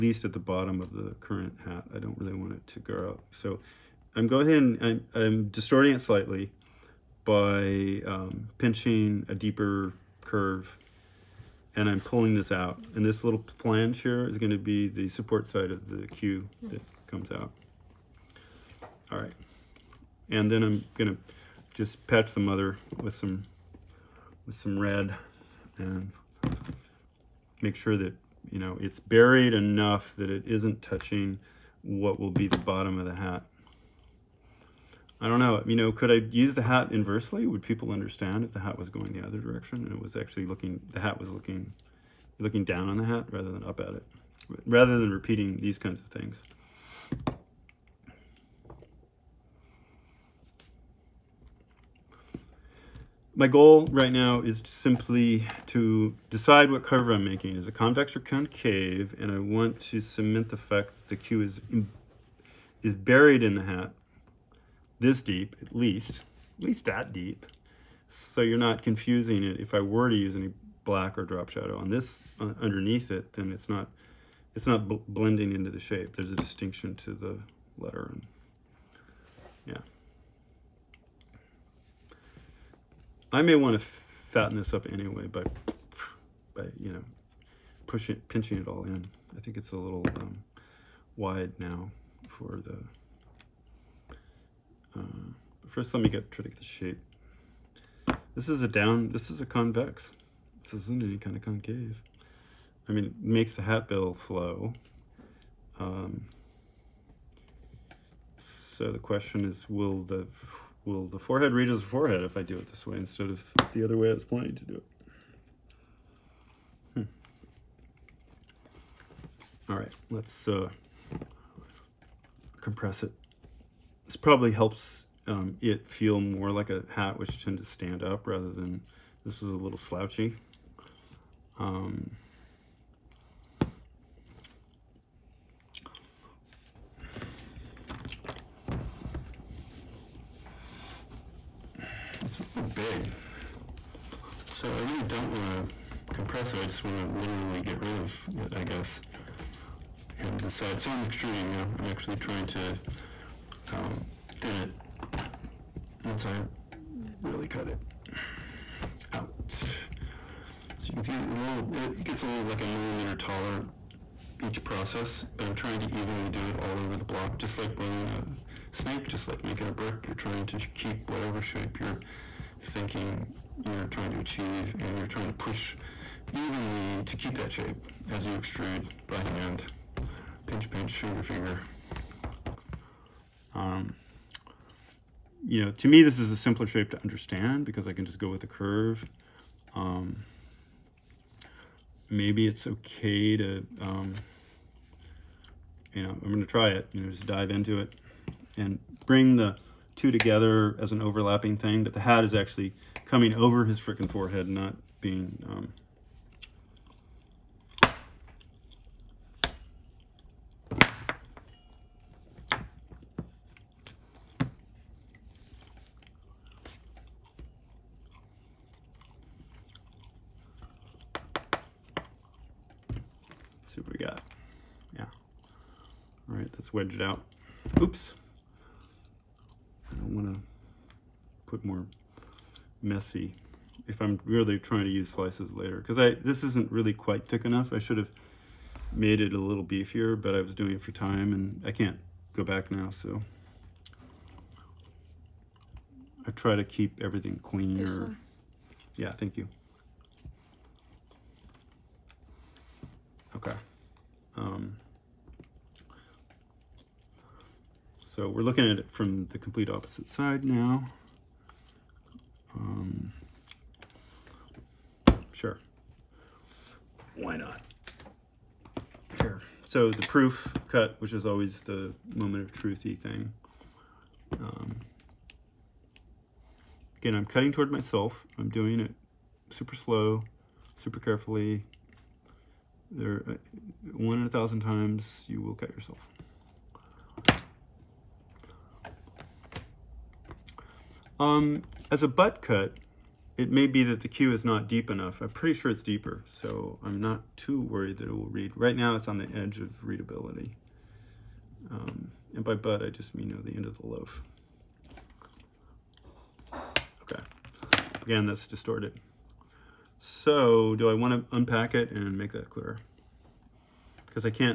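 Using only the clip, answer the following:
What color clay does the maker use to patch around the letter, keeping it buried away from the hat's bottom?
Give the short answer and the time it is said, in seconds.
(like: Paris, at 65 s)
Red, at 24 s.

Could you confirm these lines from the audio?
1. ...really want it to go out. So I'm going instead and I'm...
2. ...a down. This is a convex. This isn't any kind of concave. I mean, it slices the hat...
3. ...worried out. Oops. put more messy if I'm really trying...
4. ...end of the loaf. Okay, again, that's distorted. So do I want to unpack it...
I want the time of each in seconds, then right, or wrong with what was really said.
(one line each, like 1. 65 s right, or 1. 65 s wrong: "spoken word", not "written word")
1. 2 s wrong: "ahead", not "instead"
2. 98 s wrong: "makes", not "slices"
3. 226 s wrong: "wedged", not "worried"
4. 303 s right.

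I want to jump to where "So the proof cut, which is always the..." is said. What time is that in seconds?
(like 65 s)
269 s.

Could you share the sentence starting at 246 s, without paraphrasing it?
I try to keep everything clean.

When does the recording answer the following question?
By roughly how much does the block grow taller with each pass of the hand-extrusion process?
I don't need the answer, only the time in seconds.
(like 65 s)
162 s.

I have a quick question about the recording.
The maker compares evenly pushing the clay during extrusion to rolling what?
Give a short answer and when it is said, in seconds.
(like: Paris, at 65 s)
A snake, at 168 s.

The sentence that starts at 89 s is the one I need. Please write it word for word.
I think it's a little um, wide now for the.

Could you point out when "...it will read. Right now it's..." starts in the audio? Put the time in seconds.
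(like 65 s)
298 s.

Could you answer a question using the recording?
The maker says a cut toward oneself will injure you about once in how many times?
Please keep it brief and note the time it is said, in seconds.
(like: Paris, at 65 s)
1000, at 283 s.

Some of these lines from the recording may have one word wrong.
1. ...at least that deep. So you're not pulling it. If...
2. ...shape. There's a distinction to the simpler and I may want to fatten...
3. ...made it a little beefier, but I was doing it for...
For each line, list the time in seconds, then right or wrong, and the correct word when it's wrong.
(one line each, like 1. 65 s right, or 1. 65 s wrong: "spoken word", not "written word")
1. 66 s wrong: "confusing", not "pulling"
2. 75 s wrong: "letter", not "simpler"
3. 238 s right.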